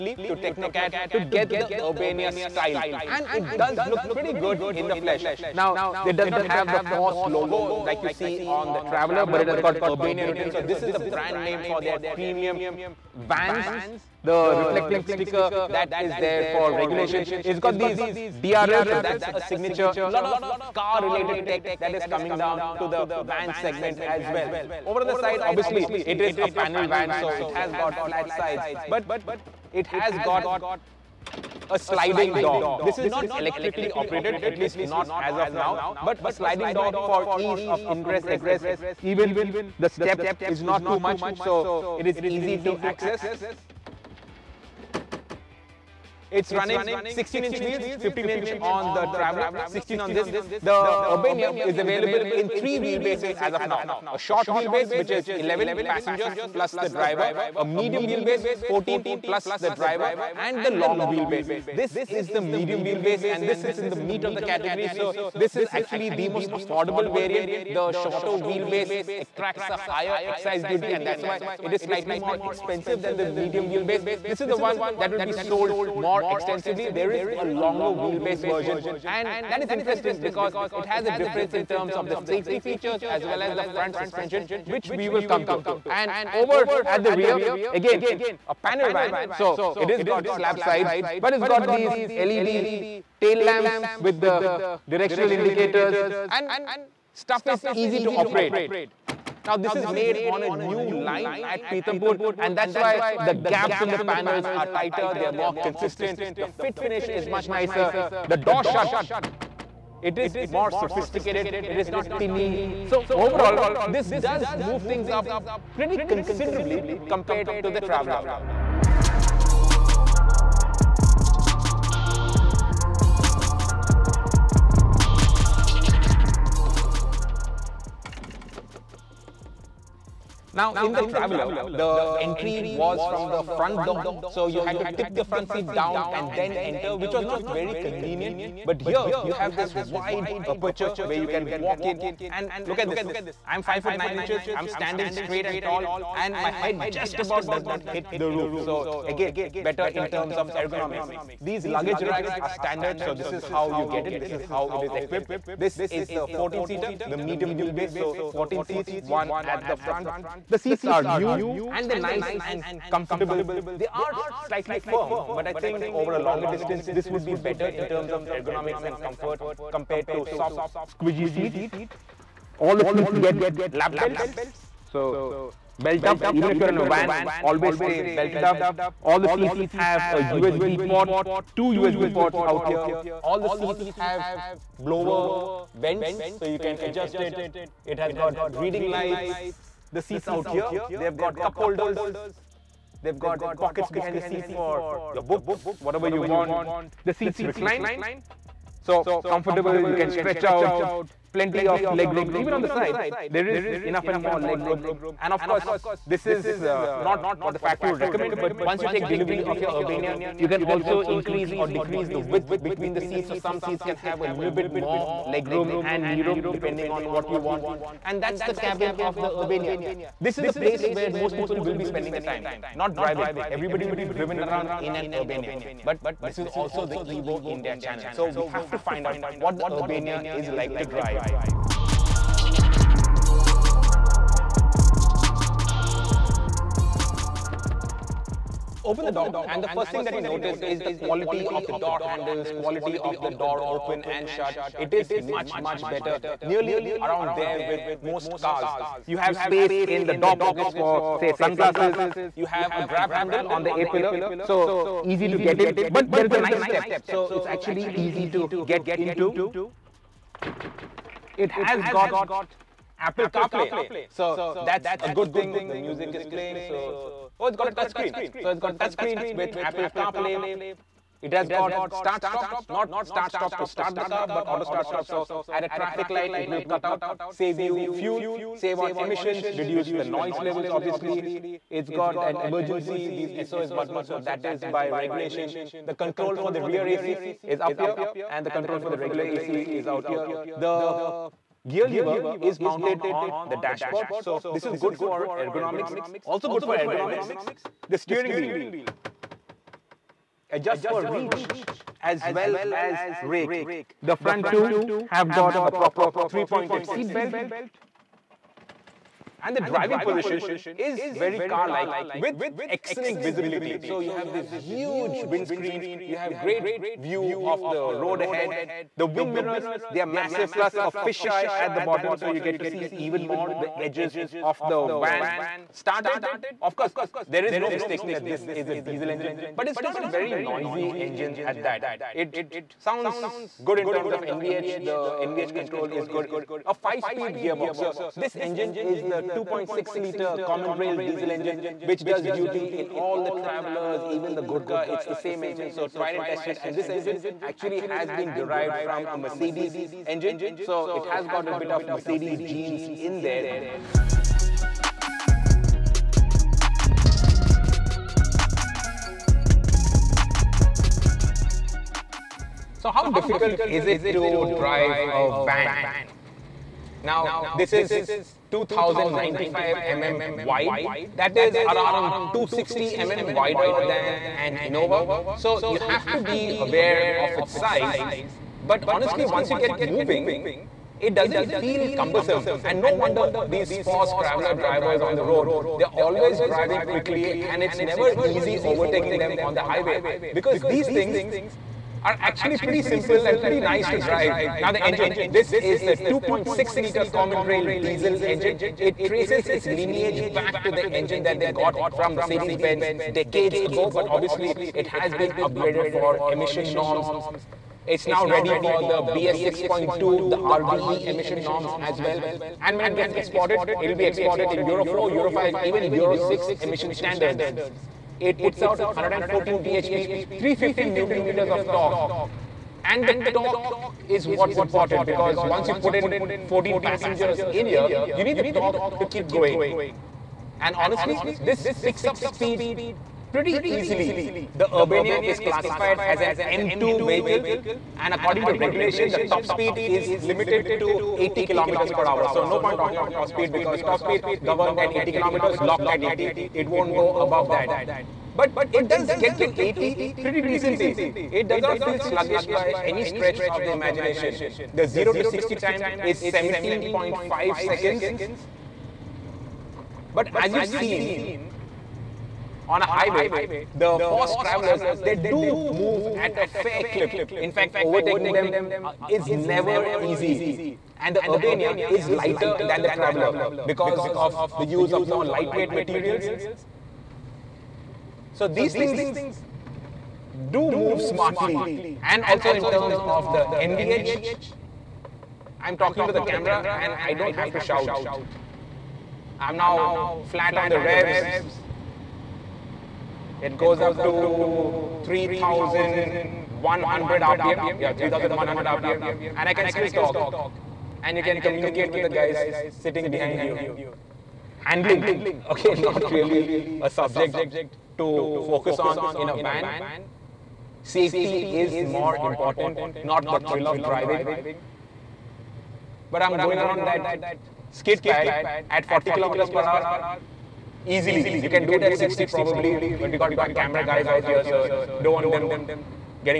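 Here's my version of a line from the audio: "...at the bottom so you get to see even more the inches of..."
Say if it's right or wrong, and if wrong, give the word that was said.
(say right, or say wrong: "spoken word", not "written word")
wrong: "edges", not "inches".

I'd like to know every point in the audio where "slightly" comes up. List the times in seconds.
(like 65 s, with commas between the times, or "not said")
71 s, 164 s.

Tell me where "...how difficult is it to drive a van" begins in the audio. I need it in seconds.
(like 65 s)
362 s.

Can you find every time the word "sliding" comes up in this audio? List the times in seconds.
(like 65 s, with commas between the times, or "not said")
31 s, 36 s.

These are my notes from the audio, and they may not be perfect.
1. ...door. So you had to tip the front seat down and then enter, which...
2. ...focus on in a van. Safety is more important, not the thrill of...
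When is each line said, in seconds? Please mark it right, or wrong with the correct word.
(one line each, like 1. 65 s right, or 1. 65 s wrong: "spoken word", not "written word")
1. 133 s right
2. 508 s right.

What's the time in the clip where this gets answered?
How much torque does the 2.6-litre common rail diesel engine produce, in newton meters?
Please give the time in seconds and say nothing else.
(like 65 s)
420 s.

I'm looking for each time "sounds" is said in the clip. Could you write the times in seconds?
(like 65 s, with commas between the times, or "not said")
332 s.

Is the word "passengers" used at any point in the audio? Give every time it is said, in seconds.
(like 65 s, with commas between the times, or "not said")
55 s, 426 s.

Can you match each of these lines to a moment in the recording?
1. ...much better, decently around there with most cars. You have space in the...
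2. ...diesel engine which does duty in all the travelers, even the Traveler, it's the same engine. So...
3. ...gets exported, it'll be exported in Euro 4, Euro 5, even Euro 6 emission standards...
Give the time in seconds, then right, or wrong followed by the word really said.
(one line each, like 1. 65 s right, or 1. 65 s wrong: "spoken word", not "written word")
1. 245 s wrong: "nearly", not "decently"
2. 340 s wrong: "Gurkha", not "Traveler"
3. 412 s right.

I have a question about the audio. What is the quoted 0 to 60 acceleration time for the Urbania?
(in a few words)
17.5 seconds.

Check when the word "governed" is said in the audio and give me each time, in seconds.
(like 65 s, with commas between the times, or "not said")
444 s.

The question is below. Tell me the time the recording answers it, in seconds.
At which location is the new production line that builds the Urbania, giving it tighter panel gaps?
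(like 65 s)
101 s.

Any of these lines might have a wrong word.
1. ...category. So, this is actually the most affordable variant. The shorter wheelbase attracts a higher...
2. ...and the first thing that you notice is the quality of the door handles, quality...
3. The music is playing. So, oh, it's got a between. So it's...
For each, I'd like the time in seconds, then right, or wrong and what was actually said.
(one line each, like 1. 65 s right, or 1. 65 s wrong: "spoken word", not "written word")
1. 64 s right
2. 239 s right
3. 265 s wrong: "touchscreen", not "between".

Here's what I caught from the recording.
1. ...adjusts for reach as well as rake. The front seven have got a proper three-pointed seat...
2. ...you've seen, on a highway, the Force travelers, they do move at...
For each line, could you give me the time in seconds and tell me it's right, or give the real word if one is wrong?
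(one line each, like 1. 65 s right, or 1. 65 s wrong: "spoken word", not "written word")
1. 300 s wrong: "two", not "seven"
2. 460 s right.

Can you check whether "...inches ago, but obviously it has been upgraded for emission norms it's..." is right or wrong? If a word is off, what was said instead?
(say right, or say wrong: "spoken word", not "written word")
wrong: "decades", not "inches".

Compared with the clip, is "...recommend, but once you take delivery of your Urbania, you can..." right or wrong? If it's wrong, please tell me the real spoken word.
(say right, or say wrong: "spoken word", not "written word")
right.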